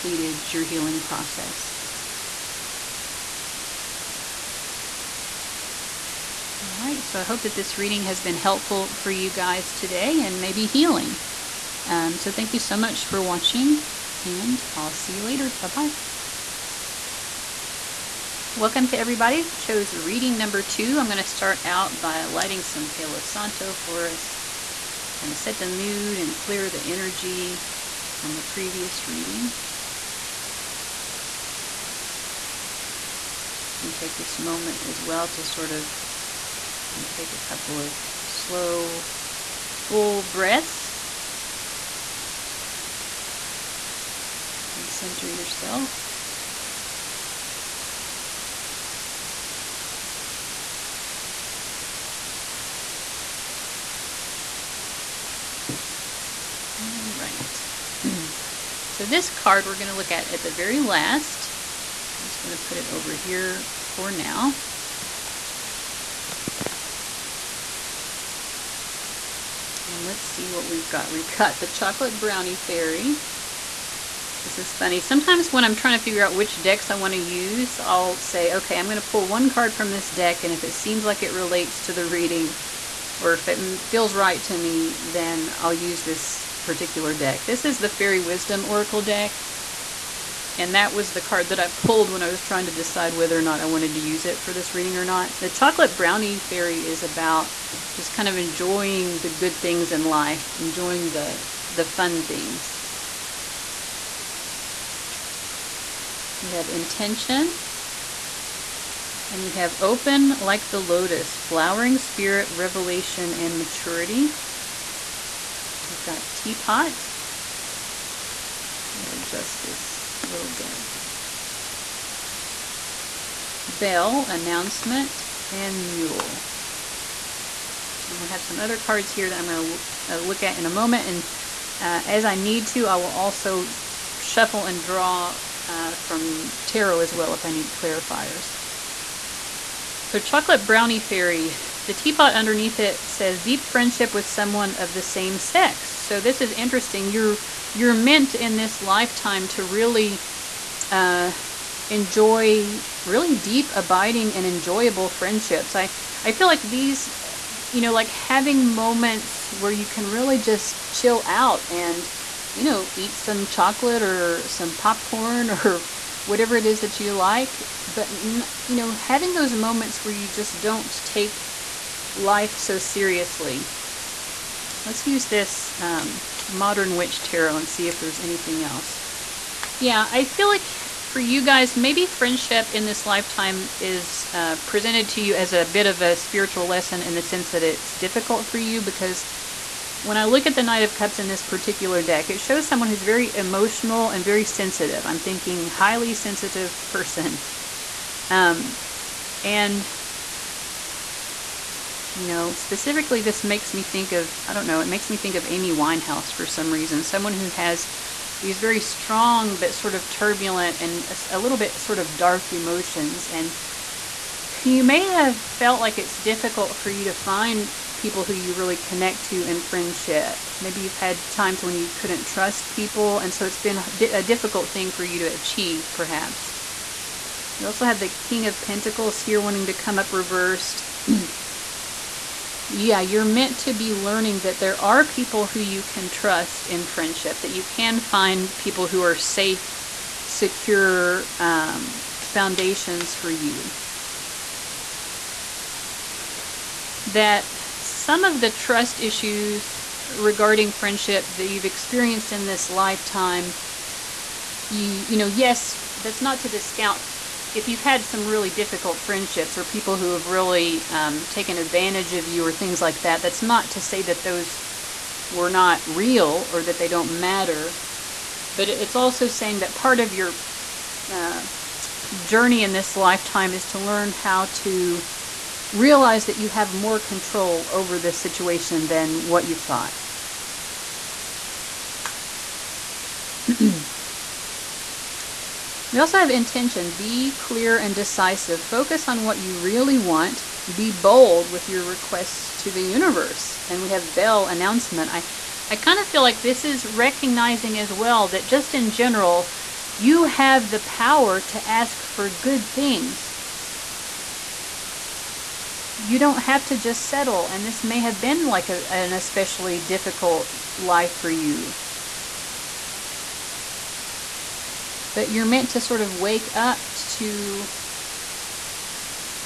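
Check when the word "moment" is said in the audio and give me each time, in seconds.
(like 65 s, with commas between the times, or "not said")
34 s, 130 s, 158 s, 169 s.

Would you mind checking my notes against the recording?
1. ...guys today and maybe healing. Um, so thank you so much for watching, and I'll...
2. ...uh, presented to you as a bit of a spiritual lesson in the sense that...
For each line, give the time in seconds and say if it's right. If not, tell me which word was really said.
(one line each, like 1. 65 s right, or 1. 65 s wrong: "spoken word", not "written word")
1. 9 s right
2. 184 s right.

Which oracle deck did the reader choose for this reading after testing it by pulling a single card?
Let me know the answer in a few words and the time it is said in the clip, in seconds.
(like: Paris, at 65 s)
Fairy Wisdom Oracle, at 87 s.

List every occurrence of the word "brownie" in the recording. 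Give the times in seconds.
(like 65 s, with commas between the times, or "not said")
72 s, 95 s, 140 s.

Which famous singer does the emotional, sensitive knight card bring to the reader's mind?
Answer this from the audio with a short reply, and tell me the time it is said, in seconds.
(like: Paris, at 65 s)
Amy Winehouse, at 205 s.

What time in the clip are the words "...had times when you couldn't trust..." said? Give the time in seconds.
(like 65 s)
220 s.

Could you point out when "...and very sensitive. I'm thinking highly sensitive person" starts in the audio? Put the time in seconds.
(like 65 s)
194 s.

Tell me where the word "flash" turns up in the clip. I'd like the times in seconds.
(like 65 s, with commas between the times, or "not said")
not said.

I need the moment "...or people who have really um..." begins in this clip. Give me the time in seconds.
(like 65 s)
259 s.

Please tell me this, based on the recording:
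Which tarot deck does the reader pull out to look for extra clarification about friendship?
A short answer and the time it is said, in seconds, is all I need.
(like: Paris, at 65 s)
Modern Witch Tarot, at 176 s.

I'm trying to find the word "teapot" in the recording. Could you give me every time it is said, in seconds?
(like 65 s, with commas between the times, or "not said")
116 s, 141 s.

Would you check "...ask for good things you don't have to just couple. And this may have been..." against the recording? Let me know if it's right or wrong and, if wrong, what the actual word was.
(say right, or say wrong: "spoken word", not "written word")
wrong: "settle", not "couple".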